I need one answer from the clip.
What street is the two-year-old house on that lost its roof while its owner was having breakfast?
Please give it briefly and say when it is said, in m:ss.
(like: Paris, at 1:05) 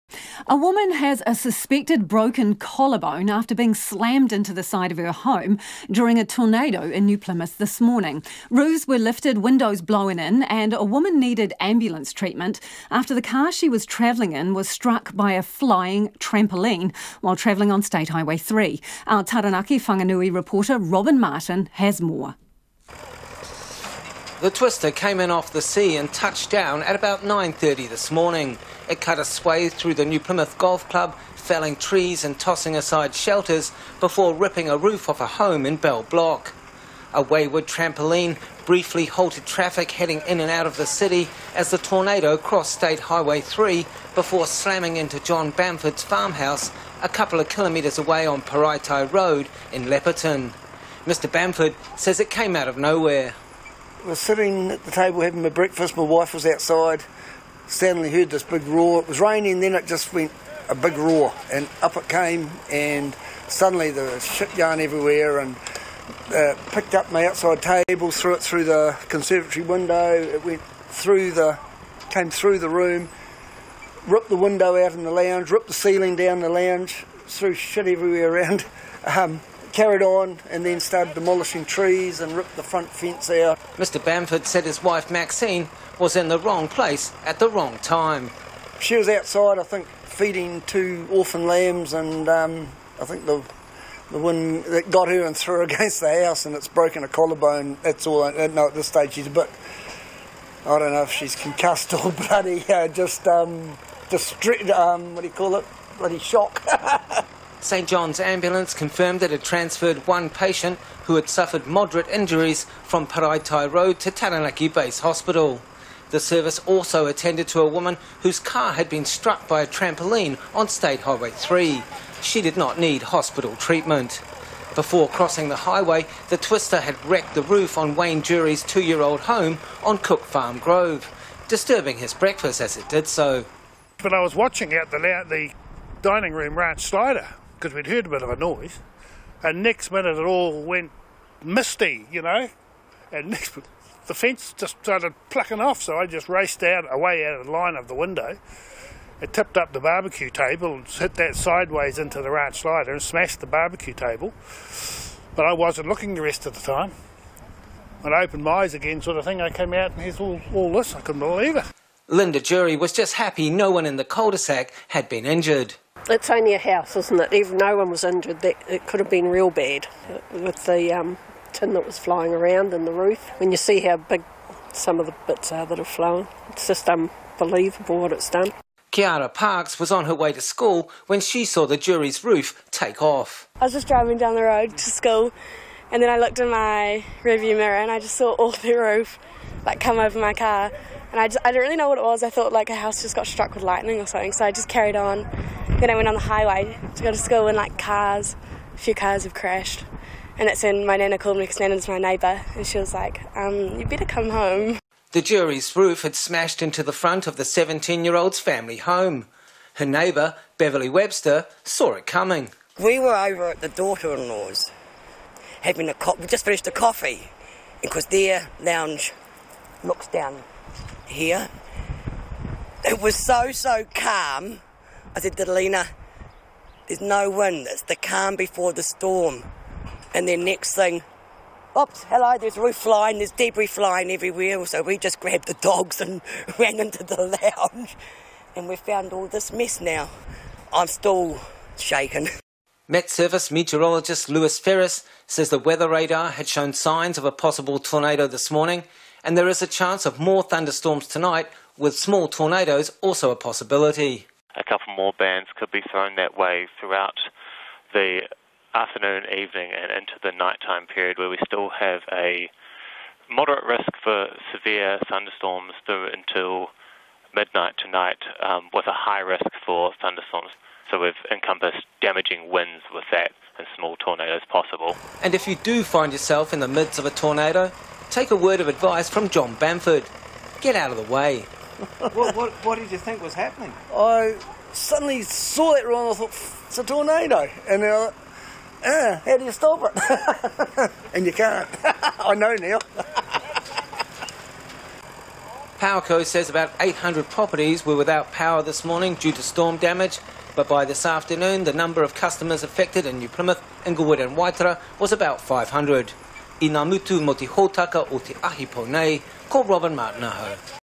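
Cook Farm Grove, at 2:09.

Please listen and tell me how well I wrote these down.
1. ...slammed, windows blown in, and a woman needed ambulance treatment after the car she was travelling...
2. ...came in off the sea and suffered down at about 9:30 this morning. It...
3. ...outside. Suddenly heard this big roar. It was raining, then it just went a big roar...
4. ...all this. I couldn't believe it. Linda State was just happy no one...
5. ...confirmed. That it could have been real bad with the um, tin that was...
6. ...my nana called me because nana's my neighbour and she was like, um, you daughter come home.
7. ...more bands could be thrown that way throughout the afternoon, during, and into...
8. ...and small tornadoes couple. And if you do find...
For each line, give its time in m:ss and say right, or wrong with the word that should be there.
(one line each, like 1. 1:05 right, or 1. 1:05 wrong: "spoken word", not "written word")
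1. 0:08 wrong: "lifted", not "slammed"
2. 0:24 wrong: "touched", not "suffered"
3. 0:56 right
4. 2:40 wrong: "Jury", not "State"
5. 2:48 wrong: "injured", not "confirmed"
6. 3:20 wrong: "better", not "daughter"
7. 4:14 wrong: "evening", not "during"
8. 4:33 wrong: "possible", not "couple".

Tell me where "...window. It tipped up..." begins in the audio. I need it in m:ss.
2:27.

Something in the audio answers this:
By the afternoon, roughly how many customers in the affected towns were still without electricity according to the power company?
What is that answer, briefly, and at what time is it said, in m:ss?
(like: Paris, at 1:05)
500, at 5:05.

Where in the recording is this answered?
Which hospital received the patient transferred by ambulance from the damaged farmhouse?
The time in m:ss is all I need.
1:54.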